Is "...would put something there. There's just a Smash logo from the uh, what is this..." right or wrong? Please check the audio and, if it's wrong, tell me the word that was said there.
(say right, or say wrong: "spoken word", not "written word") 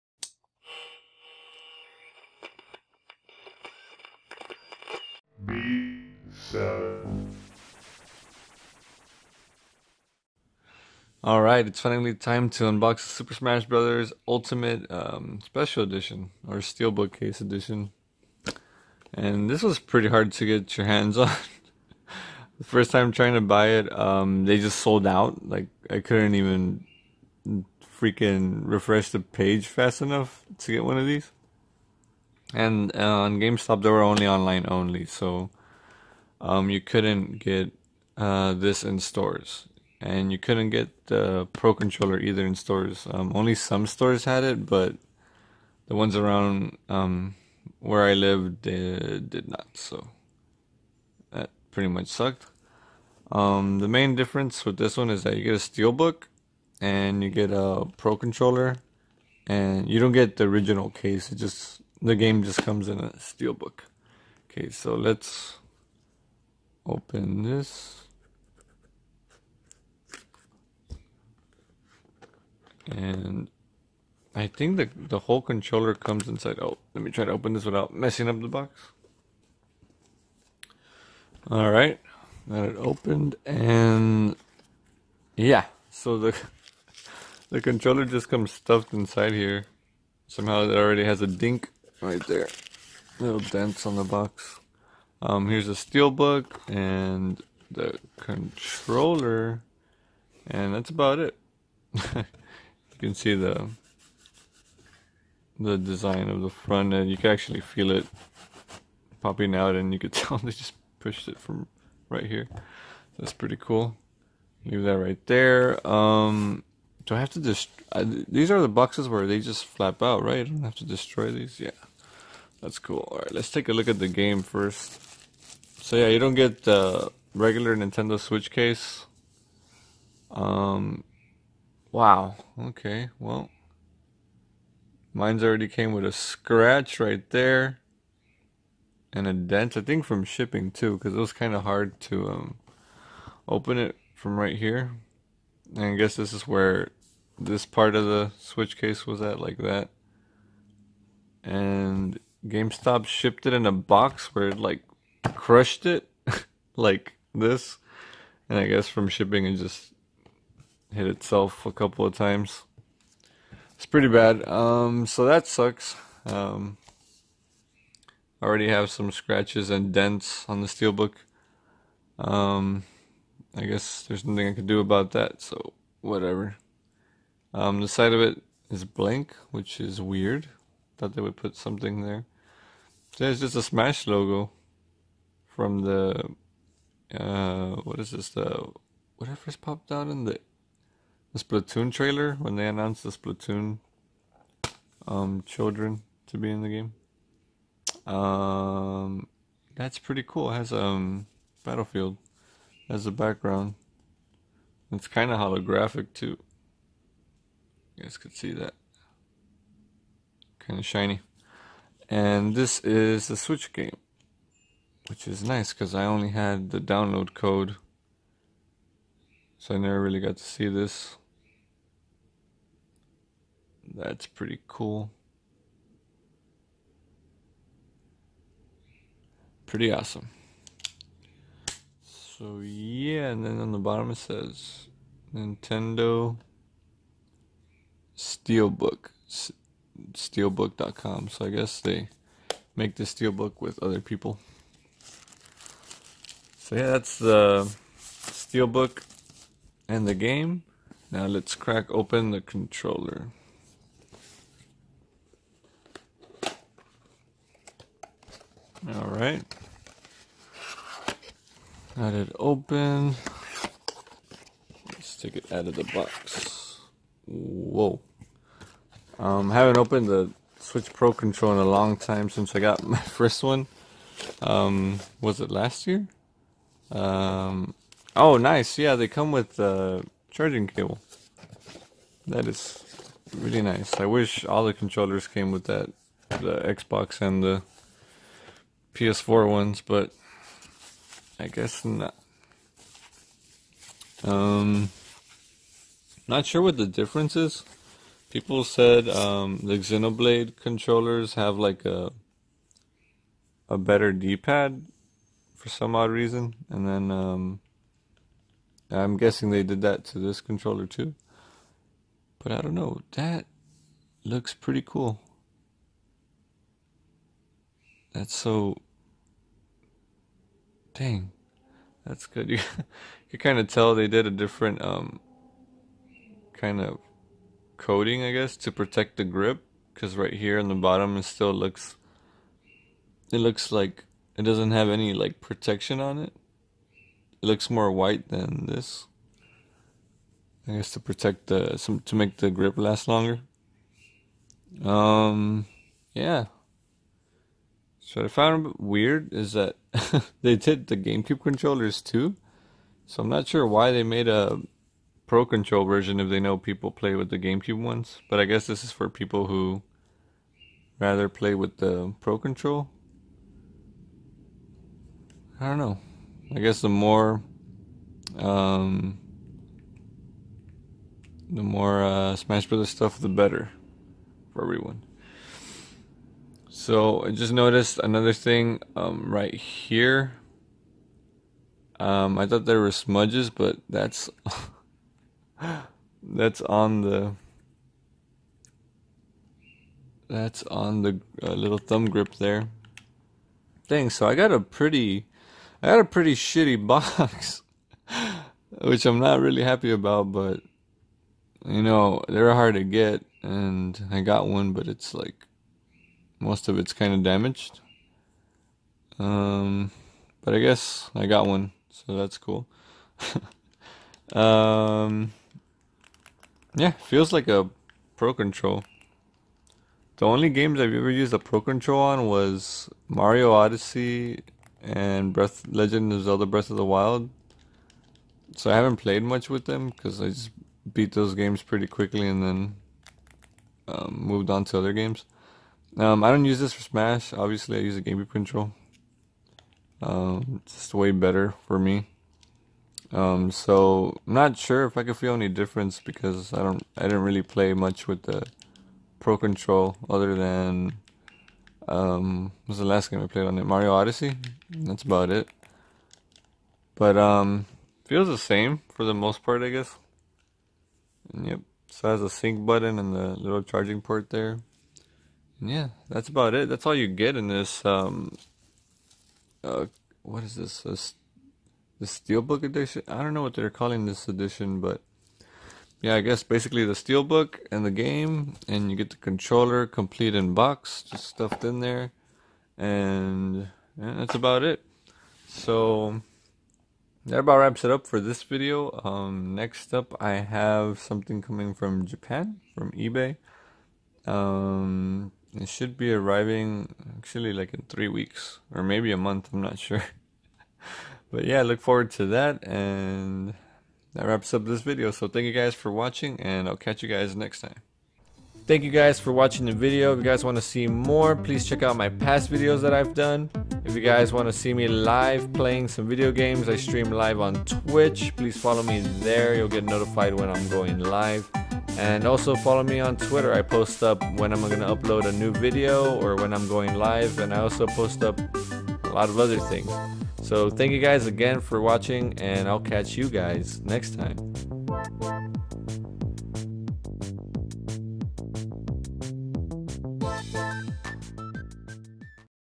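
right.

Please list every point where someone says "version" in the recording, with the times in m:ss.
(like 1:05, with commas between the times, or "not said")
5:55.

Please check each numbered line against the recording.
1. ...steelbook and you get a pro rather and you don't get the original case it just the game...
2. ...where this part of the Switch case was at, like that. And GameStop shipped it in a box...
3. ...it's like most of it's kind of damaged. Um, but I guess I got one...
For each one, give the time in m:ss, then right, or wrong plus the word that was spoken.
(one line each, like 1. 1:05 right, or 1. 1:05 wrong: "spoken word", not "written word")
1. 0:55 wrong: "controller", not "rather"
2. 2:26 right
3. 6:44 right.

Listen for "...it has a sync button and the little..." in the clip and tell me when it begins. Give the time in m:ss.
7:42.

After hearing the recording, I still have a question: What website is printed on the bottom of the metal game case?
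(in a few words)
Steelbook.com.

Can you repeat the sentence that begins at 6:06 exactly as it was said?
I guess the more, um, the more uh, Smash Brothers stuff, the better for everyone.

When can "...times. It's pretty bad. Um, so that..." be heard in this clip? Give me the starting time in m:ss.
2:42.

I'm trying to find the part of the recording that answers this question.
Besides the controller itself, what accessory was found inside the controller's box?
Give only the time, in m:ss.
4:40.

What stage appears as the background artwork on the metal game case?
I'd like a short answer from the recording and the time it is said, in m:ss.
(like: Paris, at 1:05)
Battlefield, at 3:21.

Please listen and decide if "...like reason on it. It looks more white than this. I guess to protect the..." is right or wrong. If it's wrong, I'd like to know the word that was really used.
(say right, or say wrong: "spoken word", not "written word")
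wrong: "protection", not "reason".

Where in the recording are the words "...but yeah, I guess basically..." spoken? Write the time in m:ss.
7:54.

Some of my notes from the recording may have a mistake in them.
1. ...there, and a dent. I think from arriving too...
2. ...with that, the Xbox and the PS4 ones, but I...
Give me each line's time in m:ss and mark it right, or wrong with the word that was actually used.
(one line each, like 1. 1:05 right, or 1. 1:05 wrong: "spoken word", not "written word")
1. 2:17 wrong: "shipping", not "arriving"
2. 4:45 right.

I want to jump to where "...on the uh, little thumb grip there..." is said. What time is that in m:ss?
6:30.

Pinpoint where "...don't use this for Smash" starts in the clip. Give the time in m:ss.
7:16.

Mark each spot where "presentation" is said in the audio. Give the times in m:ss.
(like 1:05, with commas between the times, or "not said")
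not said.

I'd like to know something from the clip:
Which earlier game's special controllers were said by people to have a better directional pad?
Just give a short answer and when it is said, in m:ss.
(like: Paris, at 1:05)
Xenoblade, at 4:59.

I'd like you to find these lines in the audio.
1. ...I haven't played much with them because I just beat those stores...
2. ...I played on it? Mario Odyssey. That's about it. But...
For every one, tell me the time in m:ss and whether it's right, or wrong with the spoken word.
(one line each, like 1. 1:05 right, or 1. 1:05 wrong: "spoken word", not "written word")
1. 7:08 wrong: "games", not "stores"
2. 7:33 right.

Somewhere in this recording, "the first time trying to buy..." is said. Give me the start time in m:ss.
0:22.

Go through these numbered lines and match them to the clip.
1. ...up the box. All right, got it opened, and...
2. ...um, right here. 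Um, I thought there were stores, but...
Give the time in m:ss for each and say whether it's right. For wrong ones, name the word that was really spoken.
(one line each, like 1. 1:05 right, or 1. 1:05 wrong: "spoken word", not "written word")
1. 1:18 right
2. 6:18 wrong: "smudges", not "stores".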